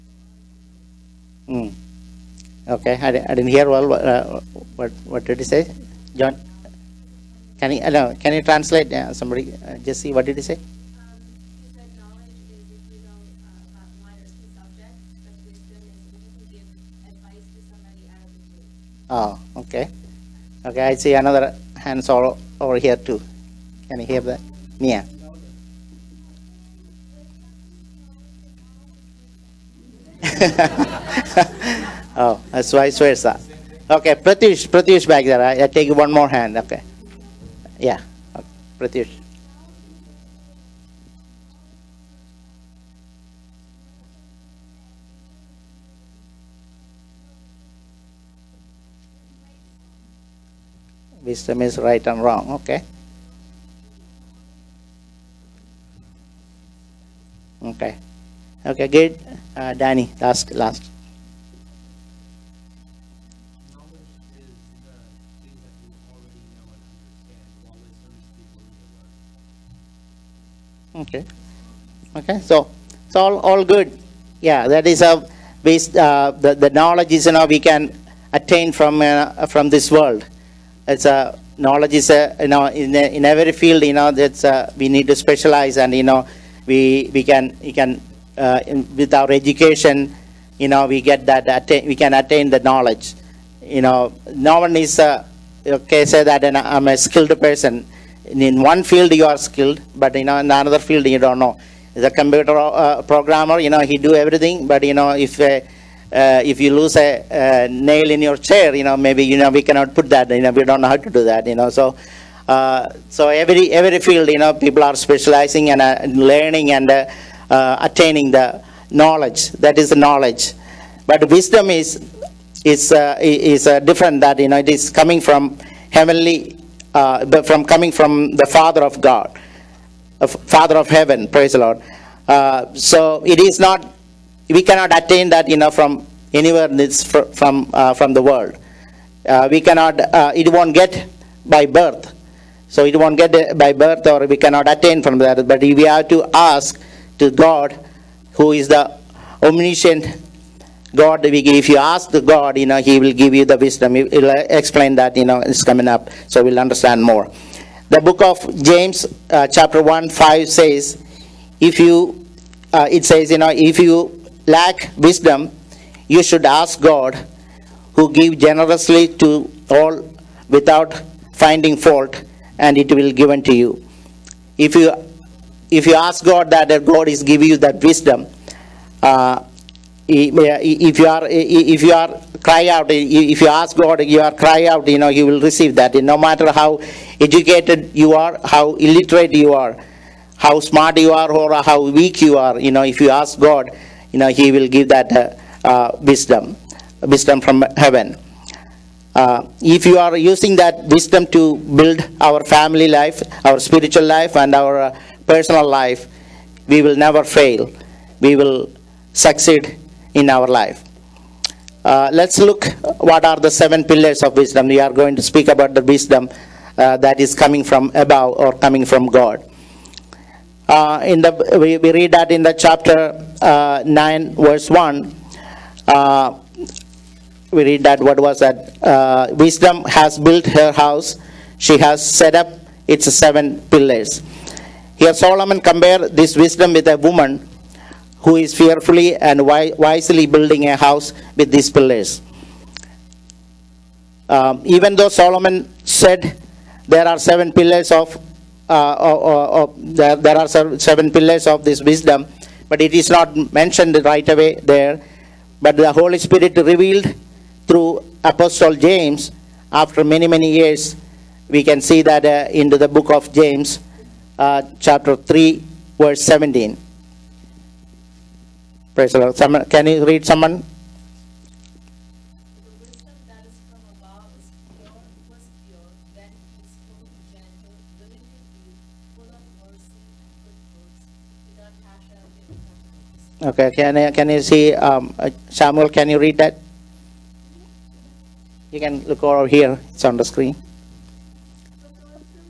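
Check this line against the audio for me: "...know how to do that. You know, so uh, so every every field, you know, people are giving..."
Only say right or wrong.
wrong.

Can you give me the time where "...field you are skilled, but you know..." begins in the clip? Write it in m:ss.
1:38.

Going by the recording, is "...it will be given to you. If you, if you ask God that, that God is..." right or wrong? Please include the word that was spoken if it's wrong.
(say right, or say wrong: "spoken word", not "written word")
right.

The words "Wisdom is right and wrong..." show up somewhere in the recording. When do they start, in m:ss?
0:51.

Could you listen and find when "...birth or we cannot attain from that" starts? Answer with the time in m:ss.
2:23.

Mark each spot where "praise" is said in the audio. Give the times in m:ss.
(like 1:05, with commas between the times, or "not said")
2:11, 4:28.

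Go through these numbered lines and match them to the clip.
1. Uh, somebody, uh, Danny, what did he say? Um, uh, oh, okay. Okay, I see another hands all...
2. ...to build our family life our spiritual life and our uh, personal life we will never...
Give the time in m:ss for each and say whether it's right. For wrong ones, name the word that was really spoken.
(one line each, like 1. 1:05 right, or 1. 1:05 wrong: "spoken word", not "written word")
1. 0:08 wrong: "Jesse", not "Danny"
2. 3:21 right.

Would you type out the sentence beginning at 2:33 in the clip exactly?
He'll uh, explain that, you know, it's coming up, so we'll understand more.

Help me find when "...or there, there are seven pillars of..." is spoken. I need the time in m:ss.
4:09.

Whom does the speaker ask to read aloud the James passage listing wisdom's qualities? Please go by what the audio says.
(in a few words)
Samuel.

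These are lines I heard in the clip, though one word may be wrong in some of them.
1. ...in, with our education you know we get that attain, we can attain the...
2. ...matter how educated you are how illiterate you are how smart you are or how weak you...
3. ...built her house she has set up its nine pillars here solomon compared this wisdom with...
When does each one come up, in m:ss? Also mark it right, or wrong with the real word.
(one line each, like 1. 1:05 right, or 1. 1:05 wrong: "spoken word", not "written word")
1. 1:28 right
2. 3:06 right
3. 3:50 wrong: "seven", not "nine".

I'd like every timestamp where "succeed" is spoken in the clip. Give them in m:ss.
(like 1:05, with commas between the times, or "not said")
3:29.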